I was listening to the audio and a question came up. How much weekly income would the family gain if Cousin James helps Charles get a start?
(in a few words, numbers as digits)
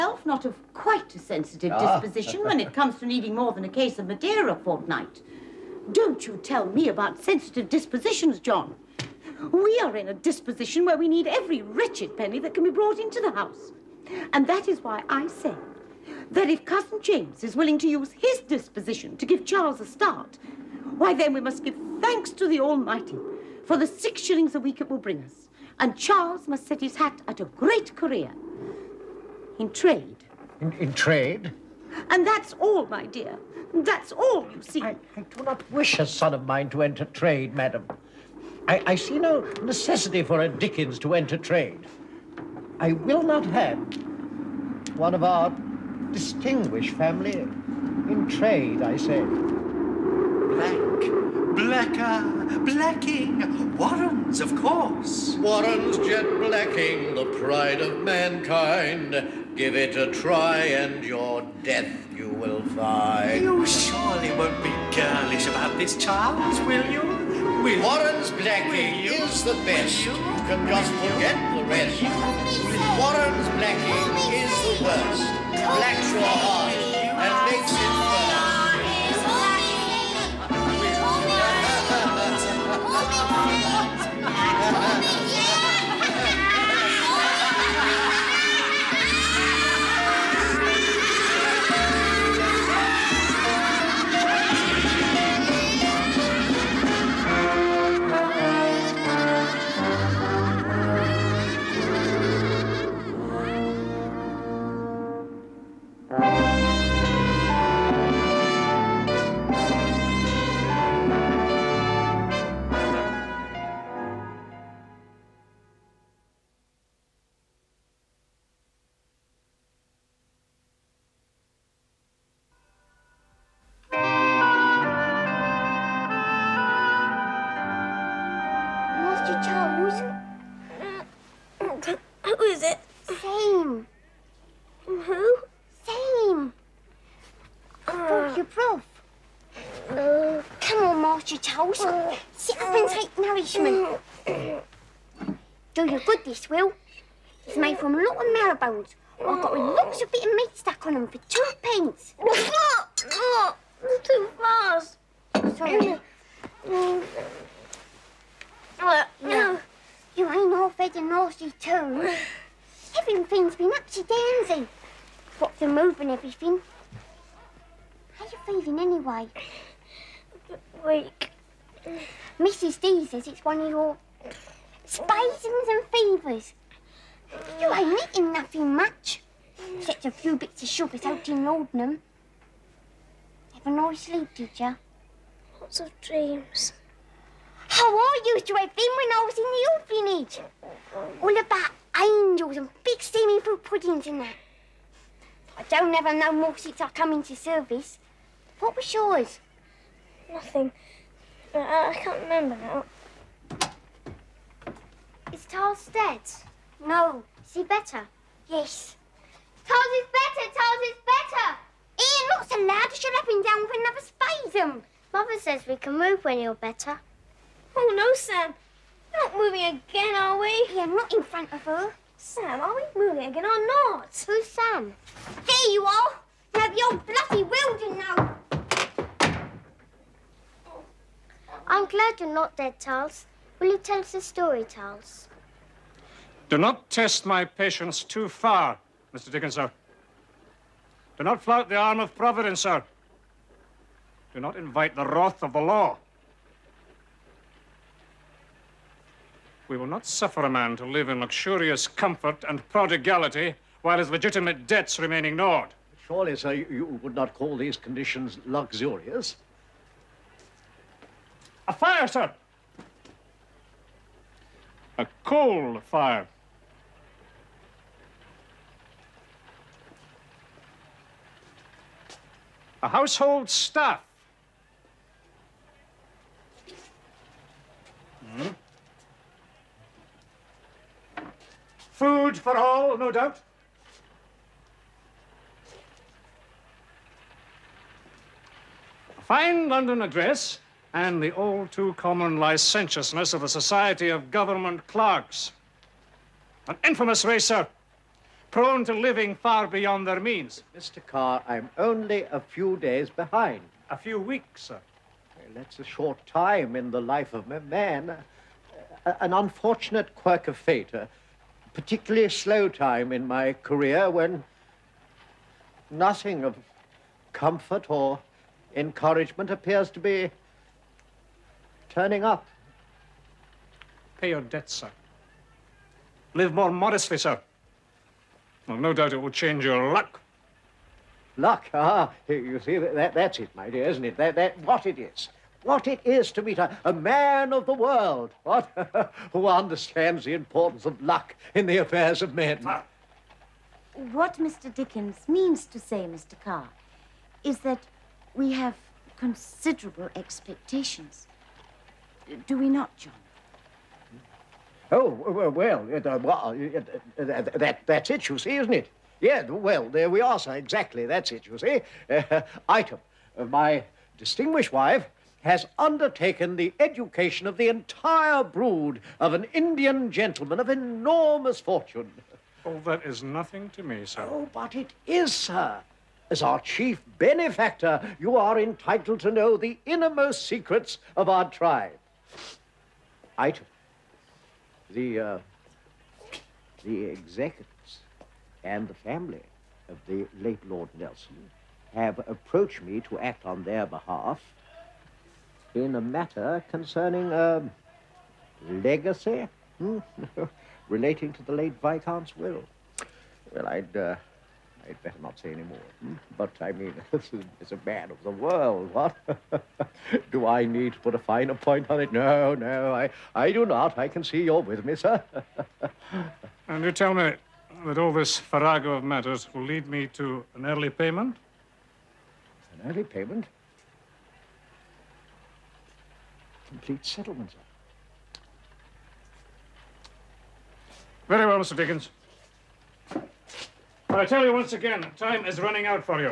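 6 shillings.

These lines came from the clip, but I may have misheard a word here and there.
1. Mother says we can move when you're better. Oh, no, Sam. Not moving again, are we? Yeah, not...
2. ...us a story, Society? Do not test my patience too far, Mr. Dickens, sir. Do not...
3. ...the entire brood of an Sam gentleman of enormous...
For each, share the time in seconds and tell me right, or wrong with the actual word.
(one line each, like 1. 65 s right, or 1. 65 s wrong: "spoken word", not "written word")
1. 215 s right
2. 233 s wrong: "Charles", not "Society"
3. 367 s wrong: "Indian", not "Sam".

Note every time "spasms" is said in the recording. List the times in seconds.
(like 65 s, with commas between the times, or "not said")
174 s, 214 s.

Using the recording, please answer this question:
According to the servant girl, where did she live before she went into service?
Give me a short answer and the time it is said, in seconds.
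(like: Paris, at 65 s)
the orphanage, at 189 s.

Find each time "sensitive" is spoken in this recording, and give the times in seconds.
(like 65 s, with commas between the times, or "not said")
1 s, 7 s.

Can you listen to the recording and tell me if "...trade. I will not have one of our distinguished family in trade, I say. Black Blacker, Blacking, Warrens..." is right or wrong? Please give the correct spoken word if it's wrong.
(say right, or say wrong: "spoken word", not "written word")
right.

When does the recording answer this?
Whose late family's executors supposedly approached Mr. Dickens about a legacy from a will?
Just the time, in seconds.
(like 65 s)
390 s.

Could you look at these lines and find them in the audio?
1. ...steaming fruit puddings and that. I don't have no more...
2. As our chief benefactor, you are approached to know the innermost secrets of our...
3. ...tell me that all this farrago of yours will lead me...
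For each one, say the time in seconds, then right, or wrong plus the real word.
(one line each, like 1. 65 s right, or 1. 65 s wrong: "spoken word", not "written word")
1. 193 s right
2. 376 s wrong: "entitled", not "approached"
3. 416 s wrong: "matters", not "yours".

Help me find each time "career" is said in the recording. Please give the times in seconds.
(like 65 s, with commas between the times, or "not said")
27 s, 313 s.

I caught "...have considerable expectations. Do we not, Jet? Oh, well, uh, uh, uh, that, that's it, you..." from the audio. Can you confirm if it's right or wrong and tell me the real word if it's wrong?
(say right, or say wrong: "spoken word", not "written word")
wrong: "John", not "Jet".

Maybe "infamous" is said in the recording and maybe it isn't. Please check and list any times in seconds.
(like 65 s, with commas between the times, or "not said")
296 s.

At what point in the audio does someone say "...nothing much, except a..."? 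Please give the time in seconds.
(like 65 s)
178 s.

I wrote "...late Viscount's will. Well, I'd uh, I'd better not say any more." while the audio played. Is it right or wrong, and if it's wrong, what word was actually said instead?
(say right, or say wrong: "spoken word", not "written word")
right.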